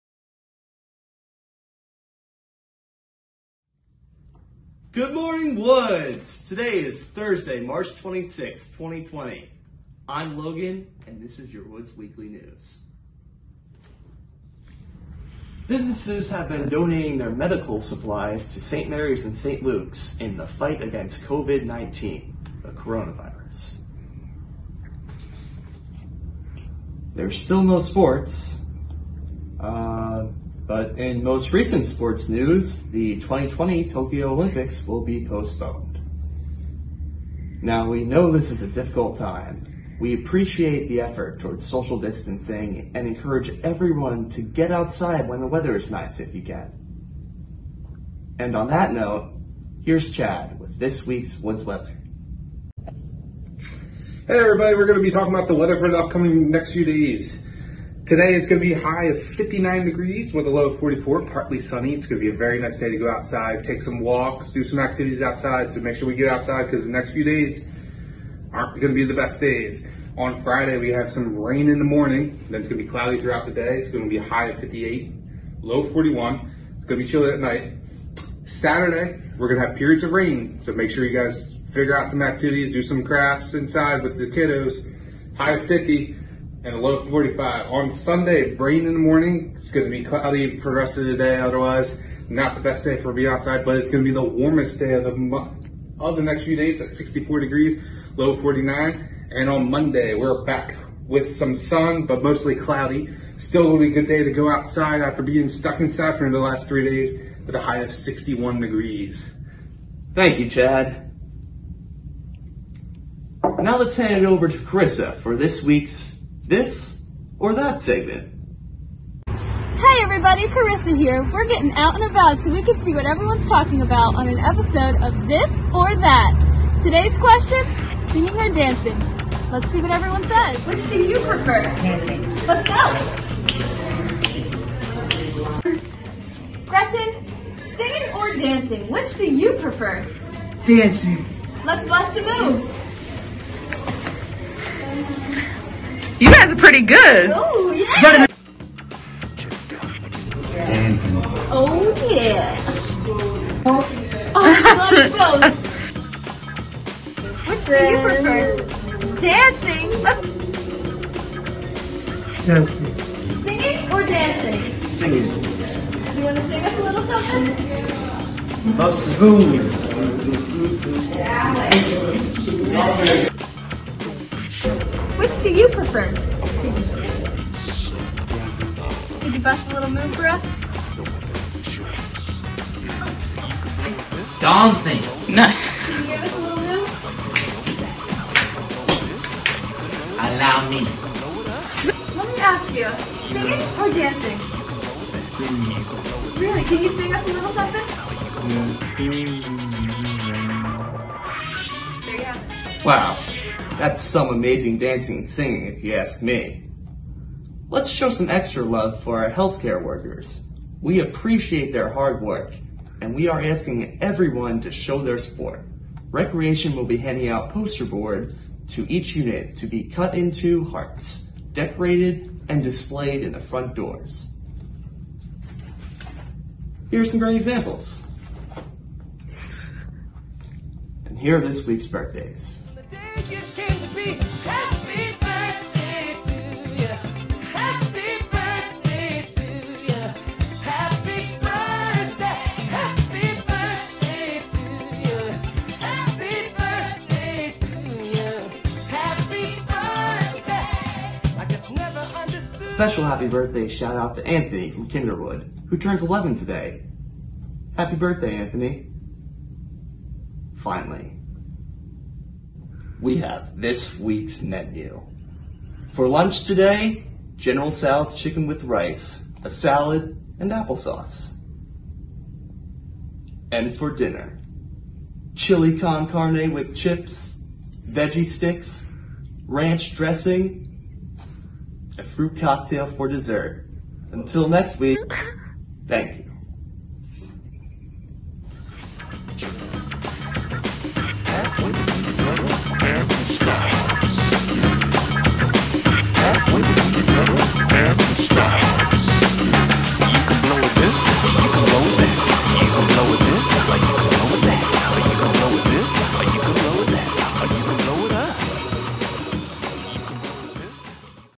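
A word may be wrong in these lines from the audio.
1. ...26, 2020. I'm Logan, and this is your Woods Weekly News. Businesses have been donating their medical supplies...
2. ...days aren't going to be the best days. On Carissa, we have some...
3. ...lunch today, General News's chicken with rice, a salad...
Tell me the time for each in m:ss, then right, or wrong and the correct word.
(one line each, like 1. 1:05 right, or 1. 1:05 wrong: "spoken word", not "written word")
1. 0:07 right
2. 1:07 wrong: "Friday", not "Carissa"
3. 4:26 wrong: "Tso", not "News".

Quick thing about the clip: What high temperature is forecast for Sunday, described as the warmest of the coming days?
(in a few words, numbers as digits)
64 degrees.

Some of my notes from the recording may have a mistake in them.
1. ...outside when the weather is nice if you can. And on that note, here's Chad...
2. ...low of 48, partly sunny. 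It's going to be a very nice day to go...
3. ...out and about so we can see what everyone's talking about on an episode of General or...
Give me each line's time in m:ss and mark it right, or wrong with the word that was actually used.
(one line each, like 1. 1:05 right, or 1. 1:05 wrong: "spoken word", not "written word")
1. 0:44 right
2. 1:00 wrong: "44", not "48"
3. 2:01 wrong: "This", not "General".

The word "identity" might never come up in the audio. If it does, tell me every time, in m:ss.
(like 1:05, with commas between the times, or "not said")
not said.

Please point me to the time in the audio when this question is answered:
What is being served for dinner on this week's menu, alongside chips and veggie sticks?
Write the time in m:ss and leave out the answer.
4:35.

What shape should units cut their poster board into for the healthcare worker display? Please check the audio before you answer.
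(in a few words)
Hearts.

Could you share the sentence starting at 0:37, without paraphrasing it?
Now, we know this is a difficult time.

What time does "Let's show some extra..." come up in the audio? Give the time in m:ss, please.
3:27.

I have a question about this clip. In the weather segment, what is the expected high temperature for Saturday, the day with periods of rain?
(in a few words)
50.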